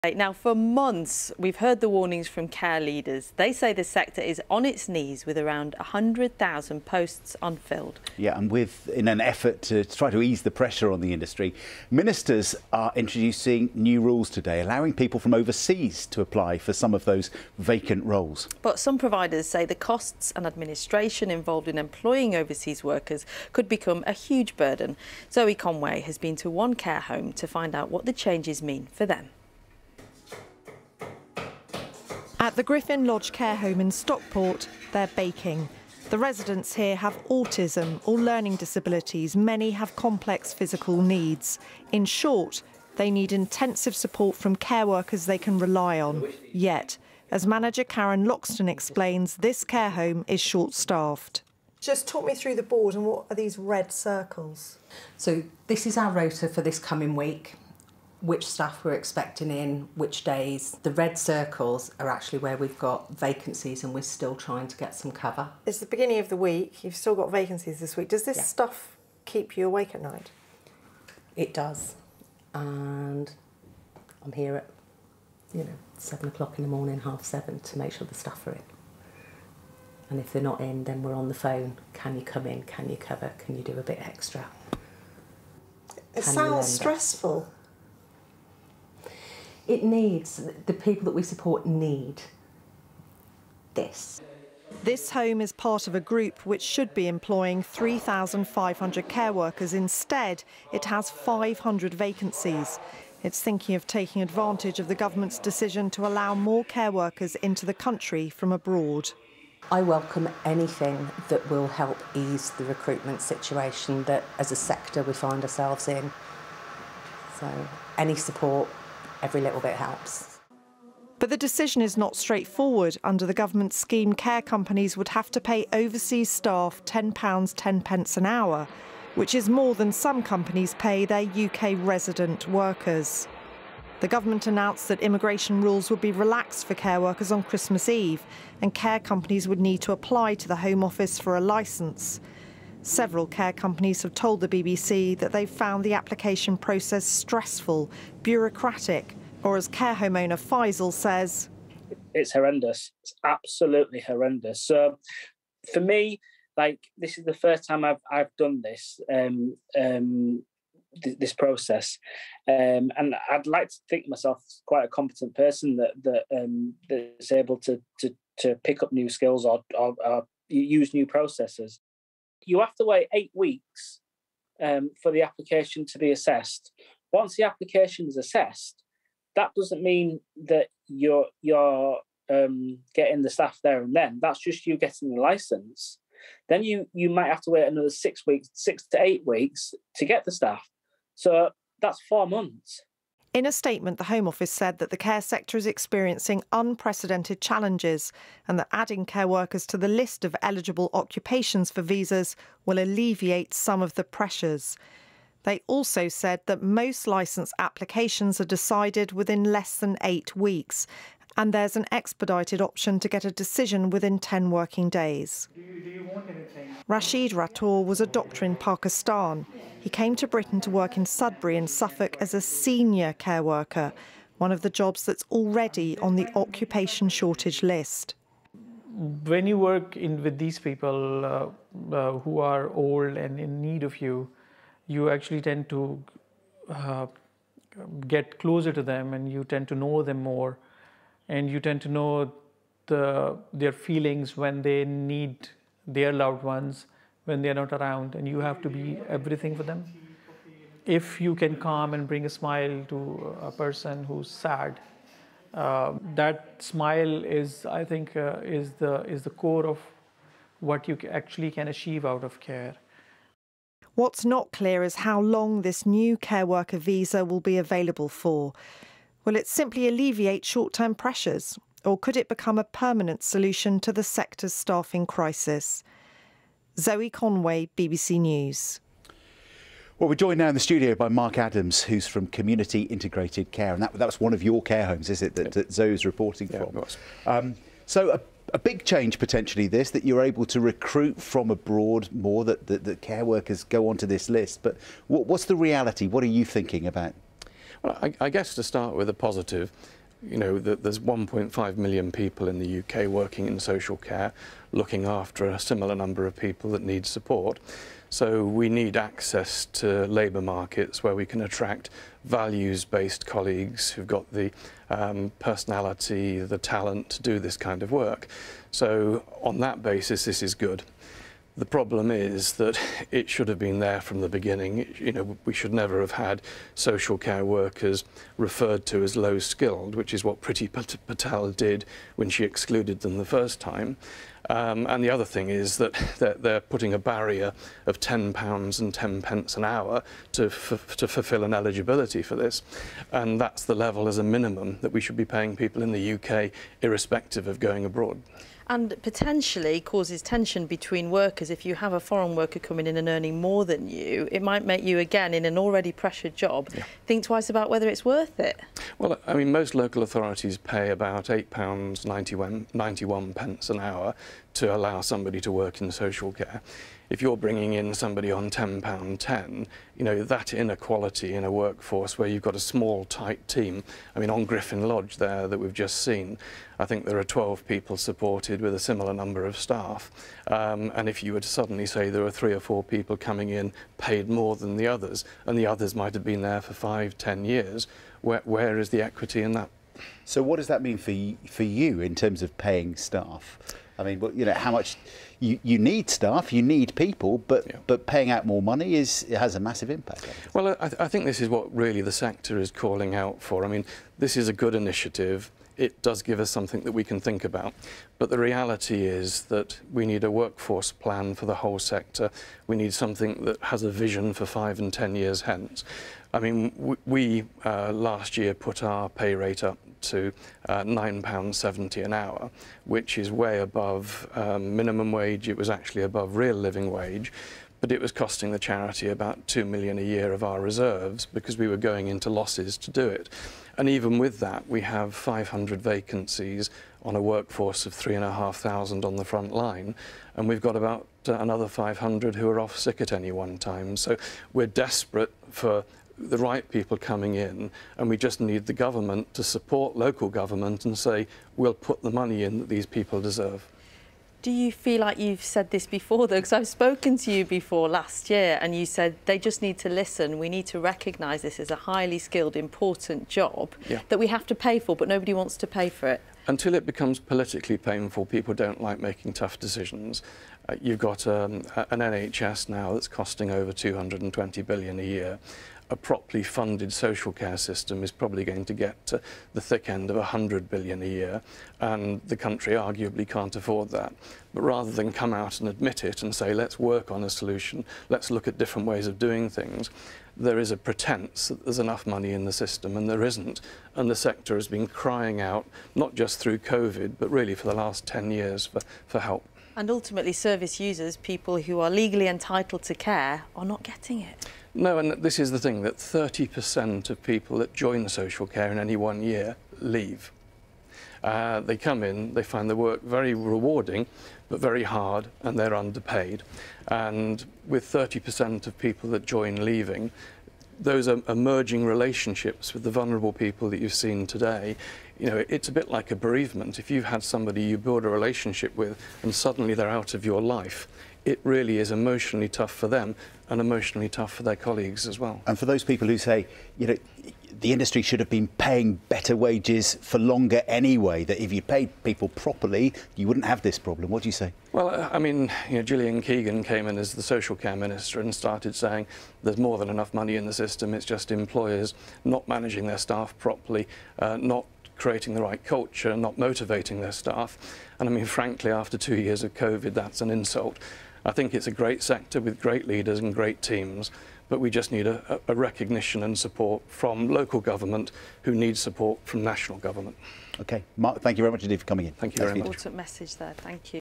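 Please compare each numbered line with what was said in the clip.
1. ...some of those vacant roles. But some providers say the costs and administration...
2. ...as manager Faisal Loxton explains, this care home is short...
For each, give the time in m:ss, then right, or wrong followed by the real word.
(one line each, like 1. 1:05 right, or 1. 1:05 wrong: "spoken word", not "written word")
1. 0:16 right
2. 0:47 wrong: "Karen", not "Faisal".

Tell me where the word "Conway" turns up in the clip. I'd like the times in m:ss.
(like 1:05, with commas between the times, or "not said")
0:25, 4:37.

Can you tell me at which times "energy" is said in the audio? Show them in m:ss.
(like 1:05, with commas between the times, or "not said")
not said.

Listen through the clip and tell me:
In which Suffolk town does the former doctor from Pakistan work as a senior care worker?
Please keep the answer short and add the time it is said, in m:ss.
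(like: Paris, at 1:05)
Sudbury, at 3:41.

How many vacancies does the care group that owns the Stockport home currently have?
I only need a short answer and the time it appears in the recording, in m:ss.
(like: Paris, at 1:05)
500, at 1:40.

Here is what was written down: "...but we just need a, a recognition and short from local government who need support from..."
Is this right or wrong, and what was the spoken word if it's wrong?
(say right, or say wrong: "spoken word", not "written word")
wrong: "support", not "short".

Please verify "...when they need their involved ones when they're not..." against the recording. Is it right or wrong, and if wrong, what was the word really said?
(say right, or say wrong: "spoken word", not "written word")
wrong: "loved", not "involved".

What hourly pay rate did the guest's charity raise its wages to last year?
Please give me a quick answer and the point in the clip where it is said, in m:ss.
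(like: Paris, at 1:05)
£9.70, at 7:00.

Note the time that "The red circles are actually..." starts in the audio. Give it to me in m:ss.
1:00.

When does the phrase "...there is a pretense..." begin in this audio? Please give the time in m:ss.
8:10.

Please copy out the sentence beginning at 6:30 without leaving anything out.
So what does that mean for, for you in terms of paying staff?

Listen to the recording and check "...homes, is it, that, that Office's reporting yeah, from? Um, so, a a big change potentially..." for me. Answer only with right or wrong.
wrong.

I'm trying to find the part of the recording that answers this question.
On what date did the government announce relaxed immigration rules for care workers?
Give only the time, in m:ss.
2:17.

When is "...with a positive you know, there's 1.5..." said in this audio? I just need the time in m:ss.
4:58.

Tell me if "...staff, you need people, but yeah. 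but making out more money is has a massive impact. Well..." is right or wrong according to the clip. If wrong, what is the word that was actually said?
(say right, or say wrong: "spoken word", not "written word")
wrong: "paying", not "making".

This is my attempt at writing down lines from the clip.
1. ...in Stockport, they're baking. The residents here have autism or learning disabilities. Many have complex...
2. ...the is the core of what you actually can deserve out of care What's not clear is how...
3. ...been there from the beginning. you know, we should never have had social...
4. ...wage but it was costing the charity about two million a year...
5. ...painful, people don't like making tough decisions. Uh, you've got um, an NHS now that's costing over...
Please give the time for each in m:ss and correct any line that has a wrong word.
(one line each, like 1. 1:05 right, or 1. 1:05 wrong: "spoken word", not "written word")
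1. 0:33 right
2. 4:18 wrong: "achieve", not "deserve"
3. 5:23 right
4. 7:06 right
5. 7:47 right.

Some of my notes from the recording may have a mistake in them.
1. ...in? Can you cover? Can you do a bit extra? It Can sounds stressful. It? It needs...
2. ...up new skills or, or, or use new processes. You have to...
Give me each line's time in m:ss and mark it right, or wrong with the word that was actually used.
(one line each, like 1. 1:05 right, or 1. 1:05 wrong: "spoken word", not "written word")
1. 1:22 right
2. 2:48 right.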